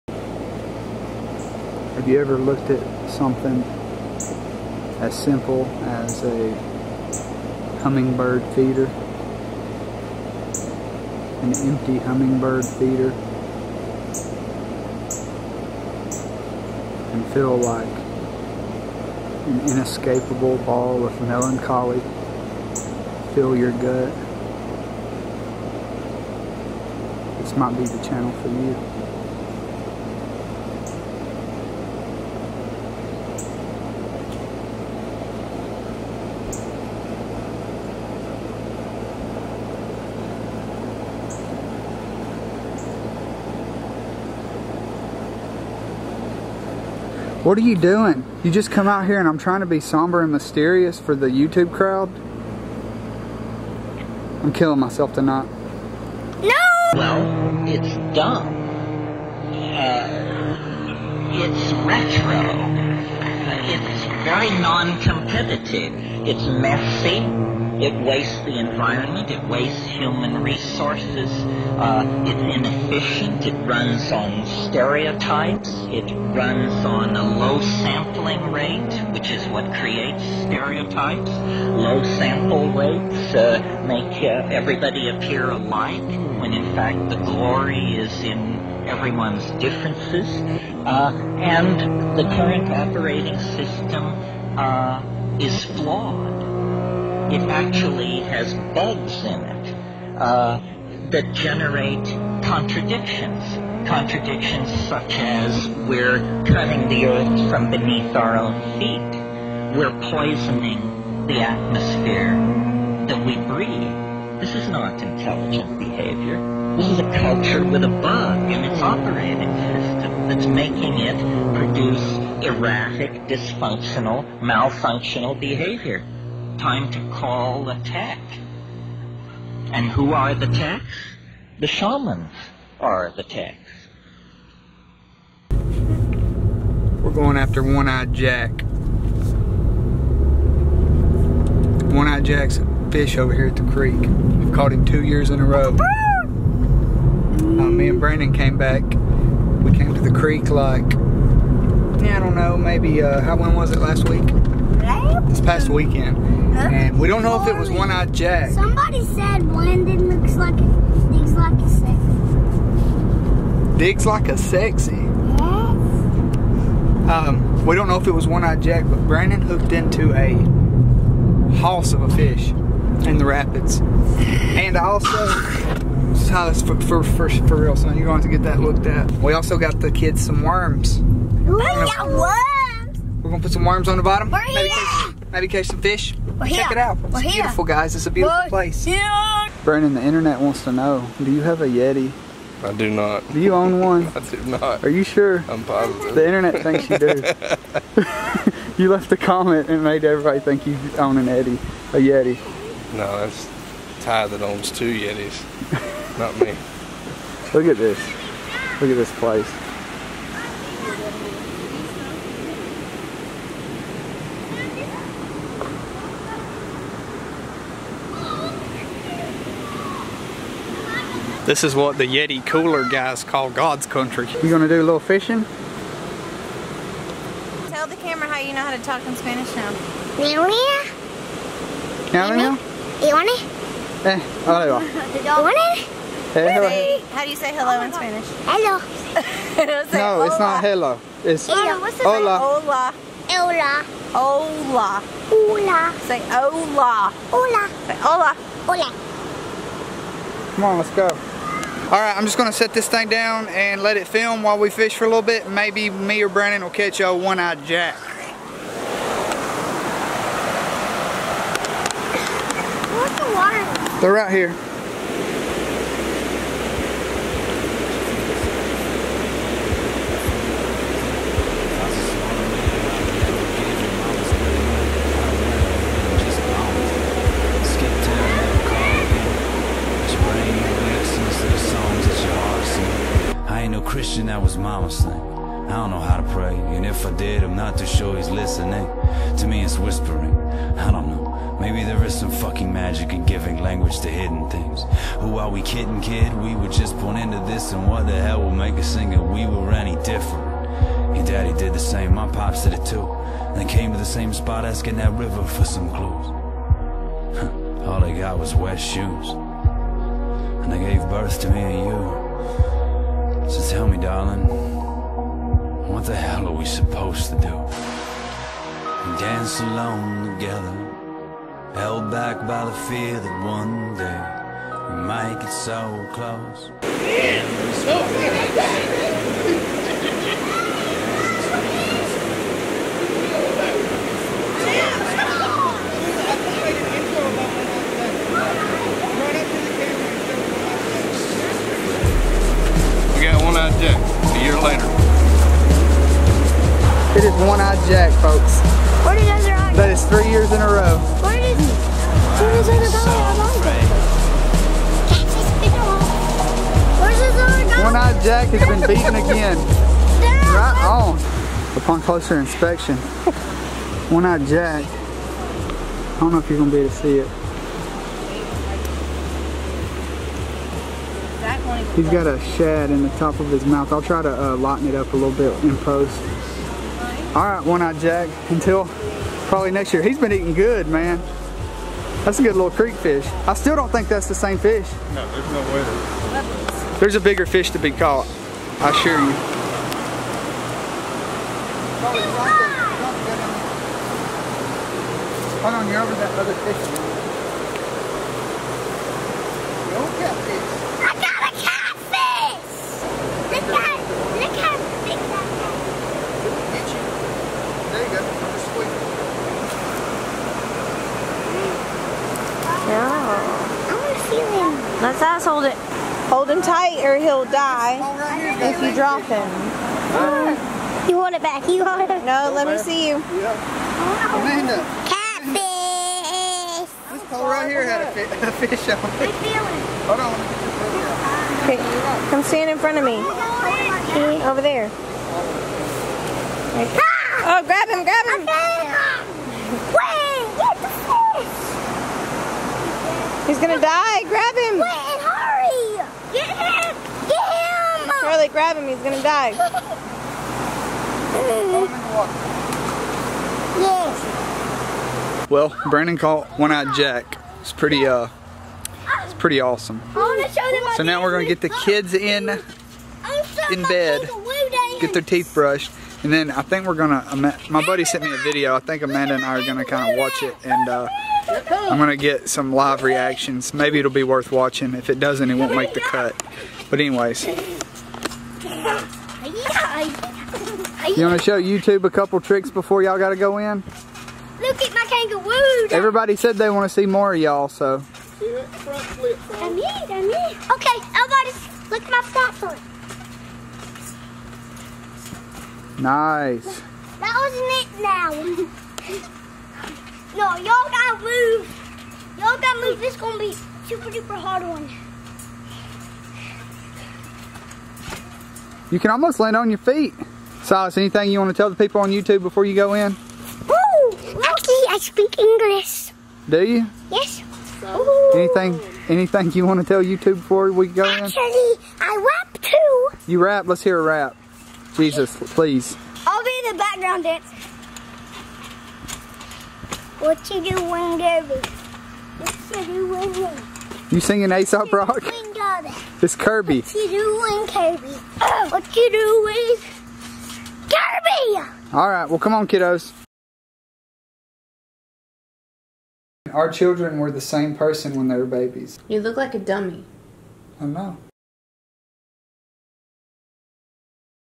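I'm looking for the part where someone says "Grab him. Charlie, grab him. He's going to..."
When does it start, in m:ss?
7:24.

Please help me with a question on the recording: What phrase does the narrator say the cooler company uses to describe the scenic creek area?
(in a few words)
God's country.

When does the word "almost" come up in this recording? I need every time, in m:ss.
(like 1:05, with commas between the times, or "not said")
8:29.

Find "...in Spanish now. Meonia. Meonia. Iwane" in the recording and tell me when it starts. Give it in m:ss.
3:49.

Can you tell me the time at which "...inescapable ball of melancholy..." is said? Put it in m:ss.
0:19.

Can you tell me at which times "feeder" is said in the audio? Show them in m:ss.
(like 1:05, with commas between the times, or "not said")
0:08, 0:12.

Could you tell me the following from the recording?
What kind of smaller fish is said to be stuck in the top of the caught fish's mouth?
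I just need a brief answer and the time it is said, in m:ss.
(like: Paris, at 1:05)
A shad, at 6:12.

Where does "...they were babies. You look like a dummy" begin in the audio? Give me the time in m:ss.
9:08.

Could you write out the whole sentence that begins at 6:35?
Hold on, you're over that other fish.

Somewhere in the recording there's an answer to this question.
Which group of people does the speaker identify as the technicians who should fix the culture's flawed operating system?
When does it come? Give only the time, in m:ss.
2:11.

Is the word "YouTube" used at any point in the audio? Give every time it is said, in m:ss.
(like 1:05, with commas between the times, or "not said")
0:51, 8:01, 8:32, 8:40.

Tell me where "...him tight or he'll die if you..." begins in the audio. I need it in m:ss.
6:56.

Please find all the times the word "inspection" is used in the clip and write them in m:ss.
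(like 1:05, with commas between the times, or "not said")
6:02.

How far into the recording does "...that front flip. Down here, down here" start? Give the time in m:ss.
8:08.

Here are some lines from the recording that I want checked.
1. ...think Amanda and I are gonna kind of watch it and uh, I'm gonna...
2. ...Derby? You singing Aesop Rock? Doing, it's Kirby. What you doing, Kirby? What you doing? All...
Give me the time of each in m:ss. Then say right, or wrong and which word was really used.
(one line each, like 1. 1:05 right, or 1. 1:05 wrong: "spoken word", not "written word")
1. 7:48 right
2. 8:53 right.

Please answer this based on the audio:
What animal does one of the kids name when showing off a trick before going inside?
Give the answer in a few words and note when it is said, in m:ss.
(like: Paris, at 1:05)
Kangaroo, at 8:05.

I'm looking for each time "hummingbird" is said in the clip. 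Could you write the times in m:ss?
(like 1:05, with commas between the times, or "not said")
0:07, 0:11.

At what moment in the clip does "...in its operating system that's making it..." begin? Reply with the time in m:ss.
1:58.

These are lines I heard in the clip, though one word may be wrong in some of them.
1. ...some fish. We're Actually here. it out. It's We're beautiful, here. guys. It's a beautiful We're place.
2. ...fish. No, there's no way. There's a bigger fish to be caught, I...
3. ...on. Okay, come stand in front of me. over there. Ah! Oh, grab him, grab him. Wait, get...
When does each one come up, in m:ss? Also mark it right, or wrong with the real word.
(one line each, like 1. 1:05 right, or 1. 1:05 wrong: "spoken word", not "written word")
1. 3:05 wrong: "Check", not "Actually"
2. 6:24 right
3. 7:10 right.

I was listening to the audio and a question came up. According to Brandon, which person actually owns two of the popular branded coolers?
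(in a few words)
Ty.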